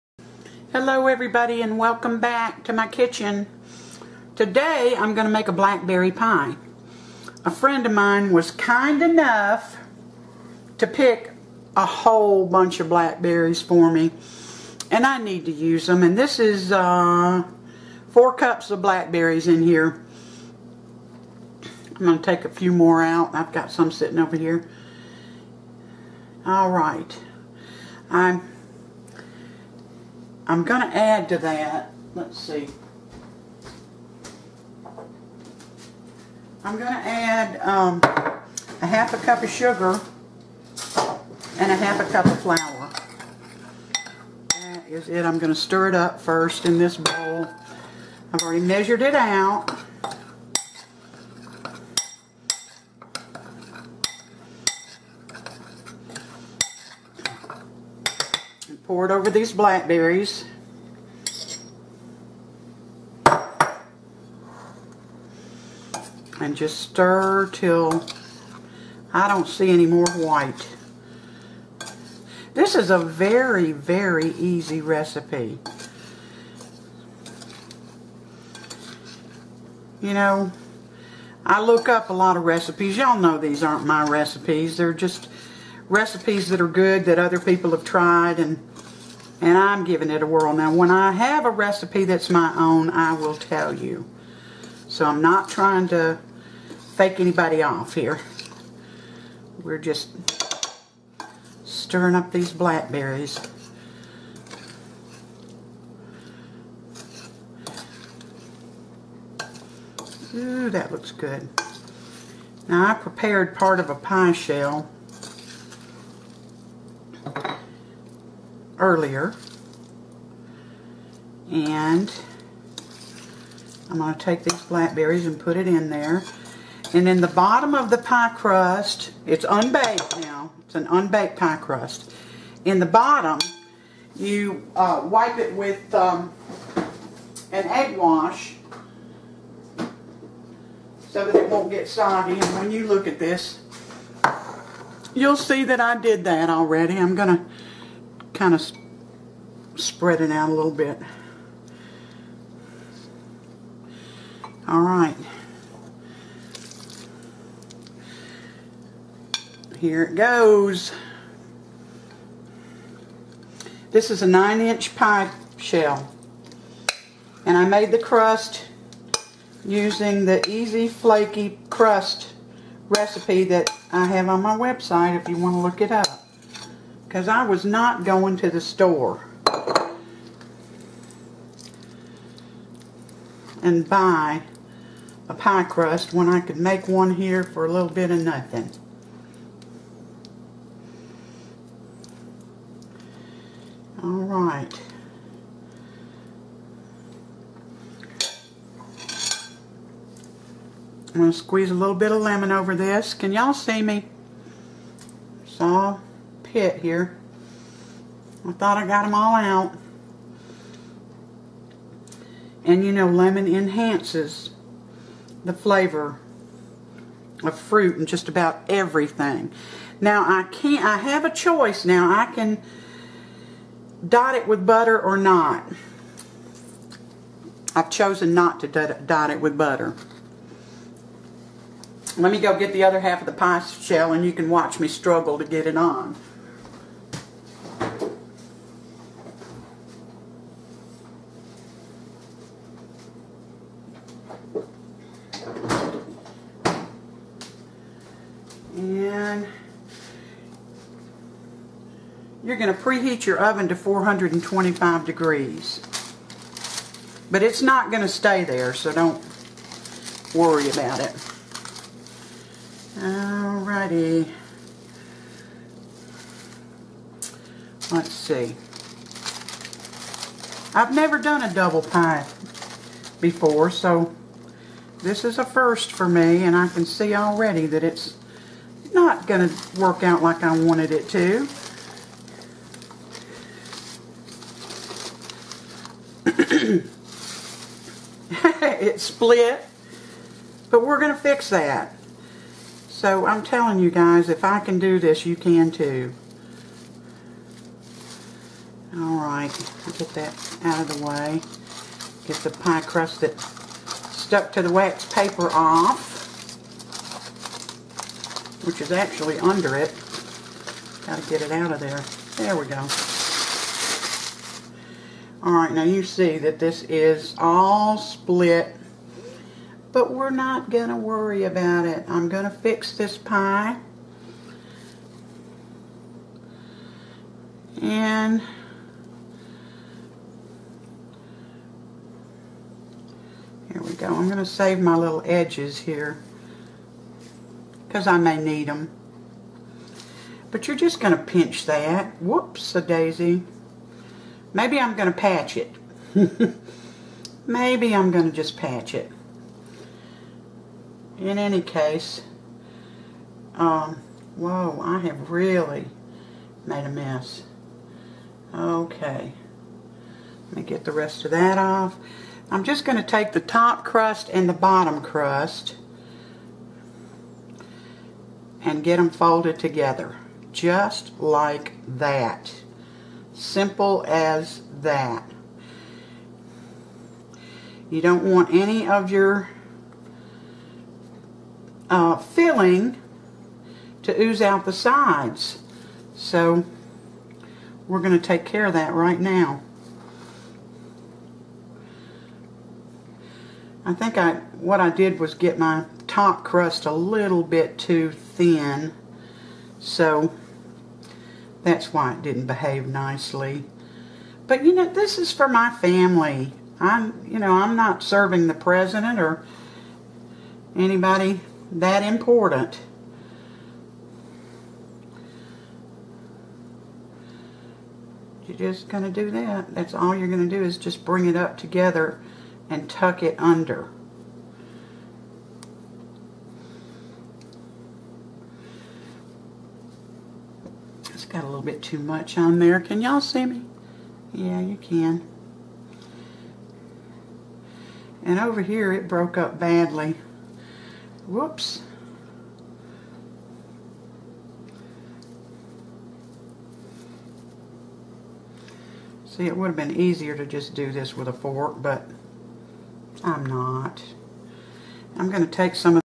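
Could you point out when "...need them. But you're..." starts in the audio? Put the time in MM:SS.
05:38.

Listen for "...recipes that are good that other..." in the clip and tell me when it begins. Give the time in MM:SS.
01:25.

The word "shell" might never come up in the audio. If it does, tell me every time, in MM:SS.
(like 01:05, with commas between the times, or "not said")
01:54, 02:45, 03:53.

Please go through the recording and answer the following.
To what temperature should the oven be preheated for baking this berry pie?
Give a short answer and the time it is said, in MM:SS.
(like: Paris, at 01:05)
425 degrees, at 04:13.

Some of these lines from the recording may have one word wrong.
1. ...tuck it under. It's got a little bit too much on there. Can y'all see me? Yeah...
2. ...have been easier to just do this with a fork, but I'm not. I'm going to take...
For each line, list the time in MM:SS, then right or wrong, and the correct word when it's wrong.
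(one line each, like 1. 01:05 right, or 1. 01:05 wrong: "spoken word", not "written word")
1. 07:02 right
2. 07:29 right.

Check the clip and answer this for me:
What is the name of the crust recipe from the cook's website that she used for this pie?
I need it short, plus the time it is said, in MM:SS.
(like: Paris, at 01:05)
Easy Flaky Crust, at 02:50.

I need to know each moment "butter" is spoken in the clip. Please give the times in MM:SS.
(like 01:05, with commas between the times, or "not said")
03:44, 03:49.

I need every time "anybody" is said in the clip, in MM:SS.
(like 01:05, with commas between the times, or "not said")
01:37, 06:50.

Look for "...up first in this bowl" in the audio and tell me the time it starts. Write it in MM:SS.
00:45.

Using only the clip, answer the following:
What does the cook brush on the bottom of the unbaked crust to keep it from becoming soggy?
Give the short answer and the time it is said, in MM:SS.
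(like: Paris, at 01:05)
egg wash, at 02:17.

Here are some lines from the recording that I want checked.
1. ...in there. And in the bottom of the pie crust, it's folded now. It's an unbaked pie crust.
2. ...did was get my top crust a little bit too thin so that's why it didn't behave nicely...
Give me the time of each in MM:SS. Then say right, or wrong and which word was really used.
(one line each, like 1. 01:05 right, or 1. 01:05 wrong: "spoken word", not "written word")
1. 02:05 wrong: "unbaked", not "folded"
2. 06:34 right.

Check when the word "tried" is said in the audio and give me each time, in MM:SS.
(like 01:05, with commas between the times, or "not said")
01:27.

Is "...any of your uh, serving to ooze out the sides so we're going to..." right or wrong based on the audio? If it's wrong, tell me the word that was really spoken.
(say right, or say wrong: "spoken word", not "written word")
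wrong: "filling", not "serving".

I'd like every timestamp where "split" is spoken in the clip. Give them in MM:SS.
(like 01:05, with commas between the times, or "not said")
04:48, 05:17.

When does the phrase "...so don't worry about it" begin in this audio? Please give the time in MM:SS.
04:18.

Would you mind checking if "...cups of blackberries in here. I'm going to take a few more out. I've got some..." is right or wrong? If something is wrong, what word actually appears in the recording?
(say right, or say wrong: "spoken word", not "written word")
right.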